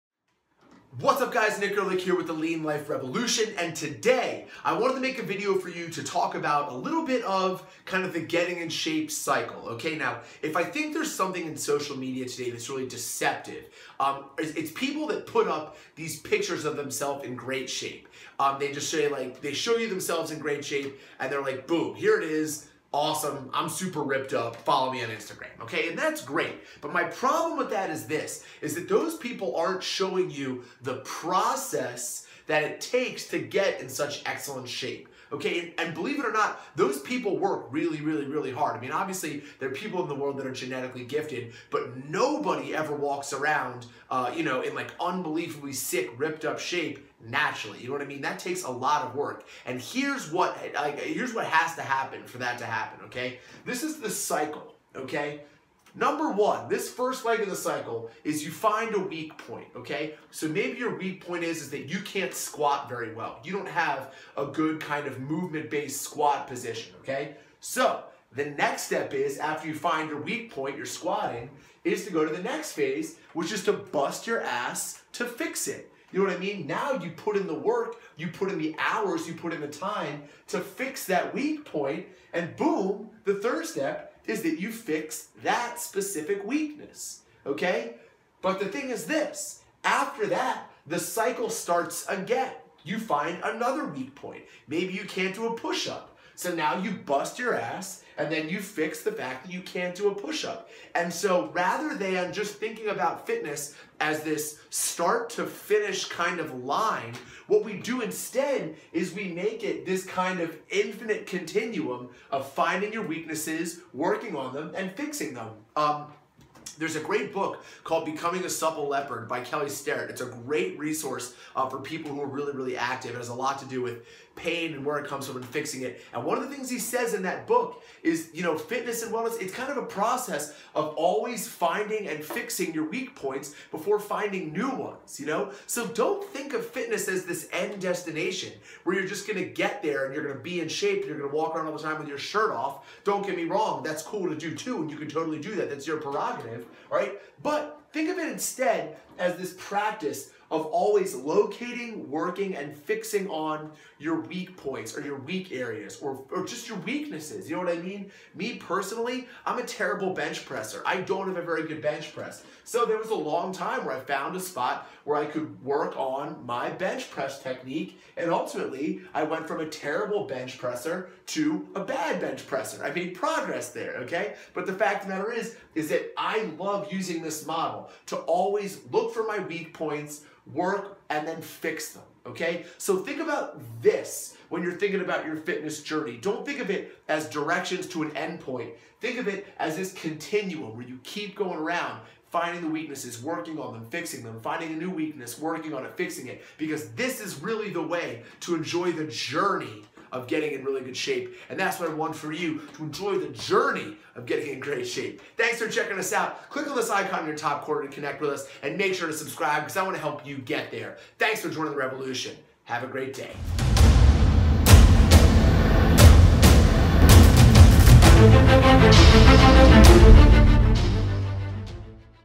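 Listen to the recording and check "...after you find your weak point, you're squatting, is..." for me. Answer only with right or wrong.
right.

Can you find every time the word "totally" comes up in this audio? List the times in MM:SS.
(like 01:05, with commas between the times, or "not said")
02:25.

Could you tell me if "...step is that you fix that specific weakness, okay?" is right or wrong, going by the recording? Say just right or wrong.
right.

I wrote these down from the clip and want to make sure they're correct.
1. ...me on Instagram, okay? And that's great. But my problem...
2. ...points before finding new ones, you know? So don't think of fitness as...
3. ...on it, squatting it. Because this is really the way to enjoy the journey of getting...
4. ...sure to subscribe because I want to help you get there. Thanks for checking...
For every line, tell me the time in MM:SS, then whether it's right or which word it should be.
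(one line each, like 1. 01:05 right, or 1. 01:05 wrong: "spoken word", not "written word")
1. 00:24 right
2. 02:13 right
3. 03:15 wrong: "fixing", not "squatting"
4. 03:28 wrong: "joining", not "checking".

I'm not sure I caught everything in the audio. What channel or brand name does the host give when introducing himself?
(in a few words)
Lean Life Revolution.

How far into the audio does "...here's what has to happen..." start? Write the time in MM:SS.
00:50.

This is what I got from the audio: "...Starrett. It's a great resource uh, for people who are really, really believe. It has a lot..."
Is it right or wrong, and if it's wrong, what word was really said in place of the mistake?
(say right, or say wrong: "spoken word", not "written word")
wrong: "active", not "believe".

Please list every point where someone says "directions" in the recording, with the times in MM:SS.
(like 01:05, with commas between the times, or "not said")
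03:07.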